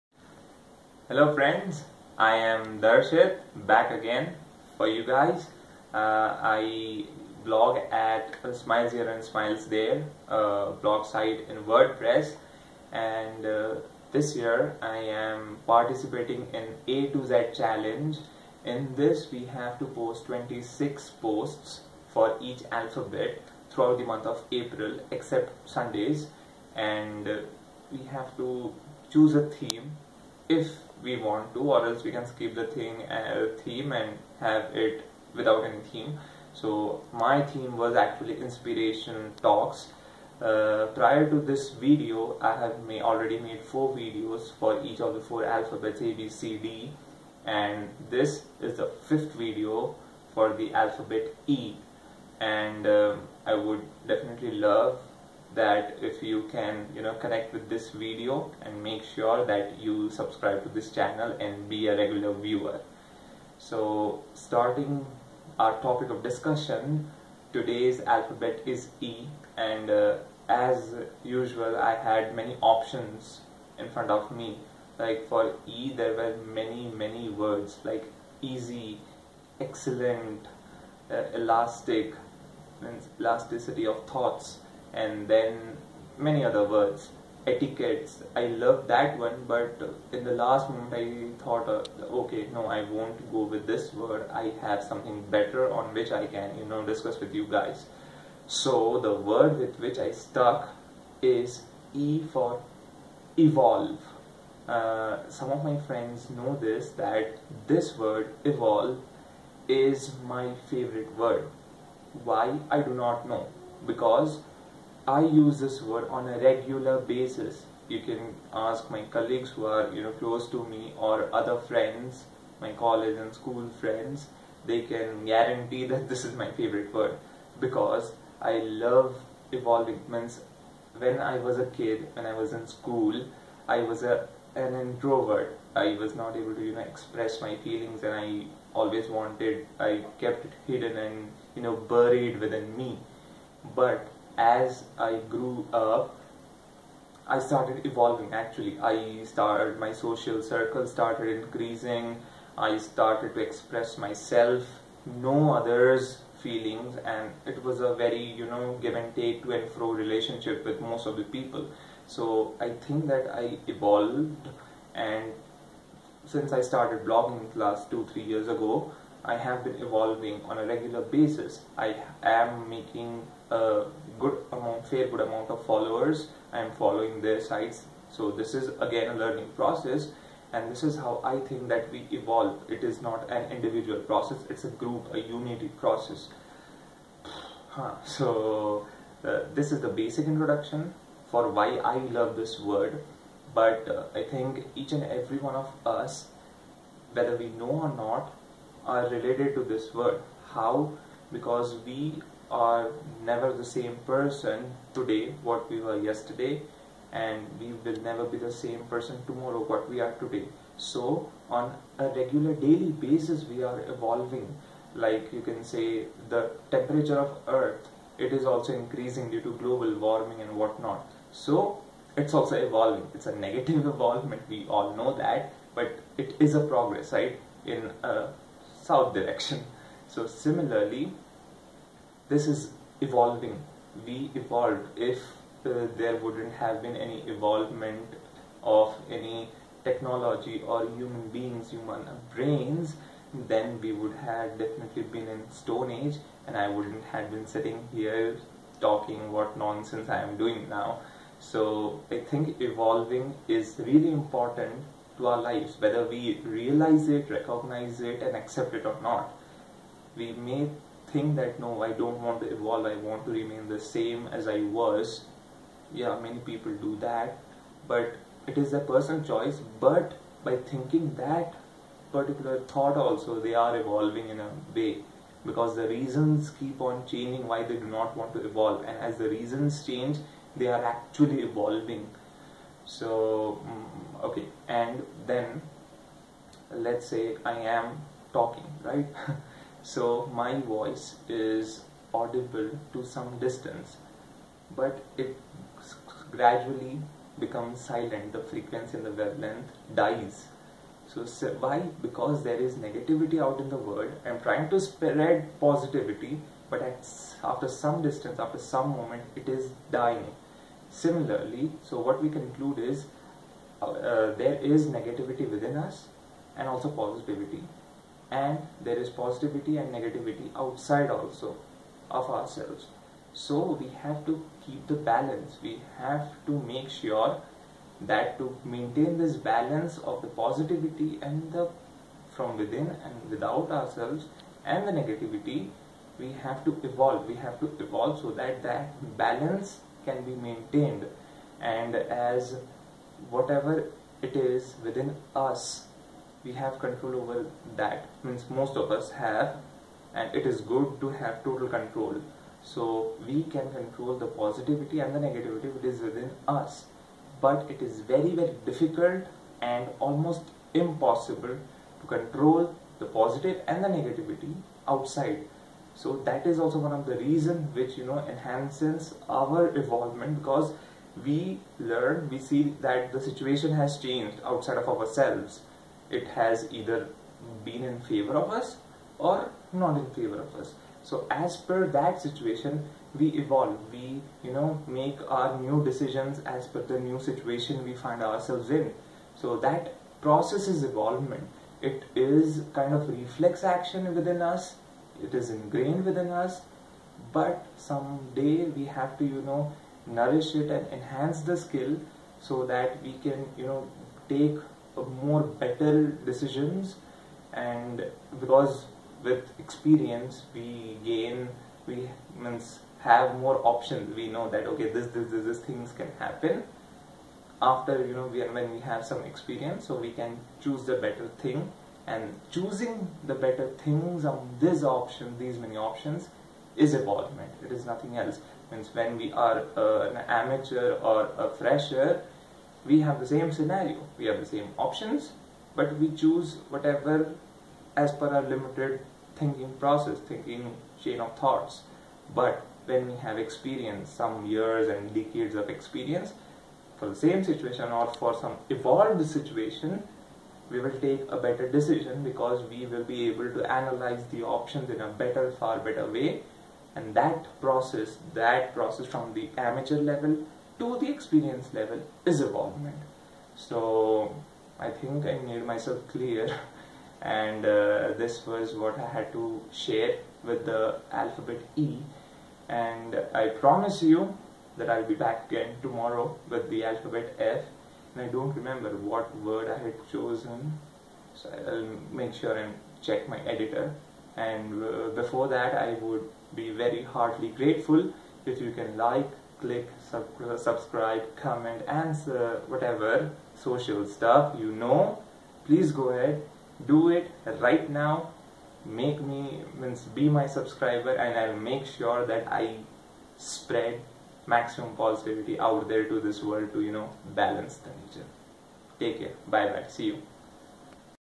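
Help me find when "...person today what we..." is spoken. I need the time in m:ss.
3:24.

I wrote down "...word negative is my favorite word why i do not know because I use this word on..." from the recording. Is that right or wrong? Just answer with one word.
wrong.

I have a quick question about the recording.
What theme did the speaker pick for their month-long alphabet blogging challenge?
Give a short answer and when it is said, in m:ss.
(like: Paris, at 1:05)
Inspiration talks, at 0:38.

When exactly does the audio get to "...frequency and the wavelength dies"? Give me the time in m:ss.
4:58.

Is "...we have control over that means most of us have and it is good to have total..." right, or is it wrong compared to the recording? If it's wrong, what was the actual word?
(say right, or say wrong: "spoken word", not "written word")
right.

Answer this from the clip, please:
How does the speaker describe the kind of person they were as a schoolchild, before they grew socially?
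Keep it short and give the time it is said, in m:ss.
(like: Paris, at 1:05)
An introvert, at 2:14.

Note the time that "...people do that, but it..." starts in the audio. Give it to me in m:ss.
4:26.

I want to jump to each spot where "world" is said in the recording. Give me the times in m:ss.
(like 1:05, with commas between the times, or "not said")
5:03, 8:26.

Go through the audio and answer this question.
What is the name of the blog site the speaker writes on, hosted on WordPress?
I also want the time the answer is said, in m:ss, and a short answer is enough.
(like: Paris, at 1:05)
Smiles Here and Smiles There, at 0:08.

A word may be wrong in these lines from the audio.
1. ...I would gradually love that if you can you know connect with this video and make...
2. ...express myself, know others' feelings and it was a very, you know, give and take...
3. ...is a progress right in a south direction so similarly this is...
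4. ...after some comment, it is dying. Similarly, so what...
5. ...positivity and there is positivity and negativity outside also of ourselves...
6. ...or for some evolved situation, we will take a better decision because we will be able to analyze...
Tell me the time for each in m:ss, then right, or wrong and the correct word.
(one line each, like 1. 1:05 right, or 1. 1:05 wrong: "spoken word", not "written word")
1. 0:53 wrong: "definitely", not "gradually"
2. 2:33 right
3. 3:46 right
4. 5:08 wrong: "moment", not "comment"
5. 5:16 right
6. 7:27 right.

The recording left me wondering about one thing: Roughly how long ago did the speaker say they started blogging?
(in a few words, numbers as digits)
Two, three years ago.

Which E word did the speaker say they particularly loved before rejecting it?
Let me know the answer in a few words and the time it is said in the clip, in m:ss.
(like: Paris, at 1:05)
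Etiquettes, at 1:27.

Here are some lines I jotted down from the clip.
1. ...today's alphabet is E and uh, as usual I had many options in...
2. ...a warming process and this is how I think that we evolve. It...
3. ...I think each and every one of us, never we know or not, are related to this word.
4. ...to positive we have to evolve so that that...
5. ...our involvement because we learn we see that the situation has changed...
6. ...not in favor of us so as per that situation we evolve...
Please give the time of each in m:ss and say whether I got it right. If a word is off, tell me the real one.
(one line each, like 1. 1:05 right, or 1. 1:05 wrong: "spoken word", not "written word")
1. 1:07 right
2. 2:59 wrong: "learning", not "warming"
3. 3:14 wrong: "whether", not "never"
4. 5:36 wrong: "evolve", not "positive"
5. 6:09 right
6. 6:19 right.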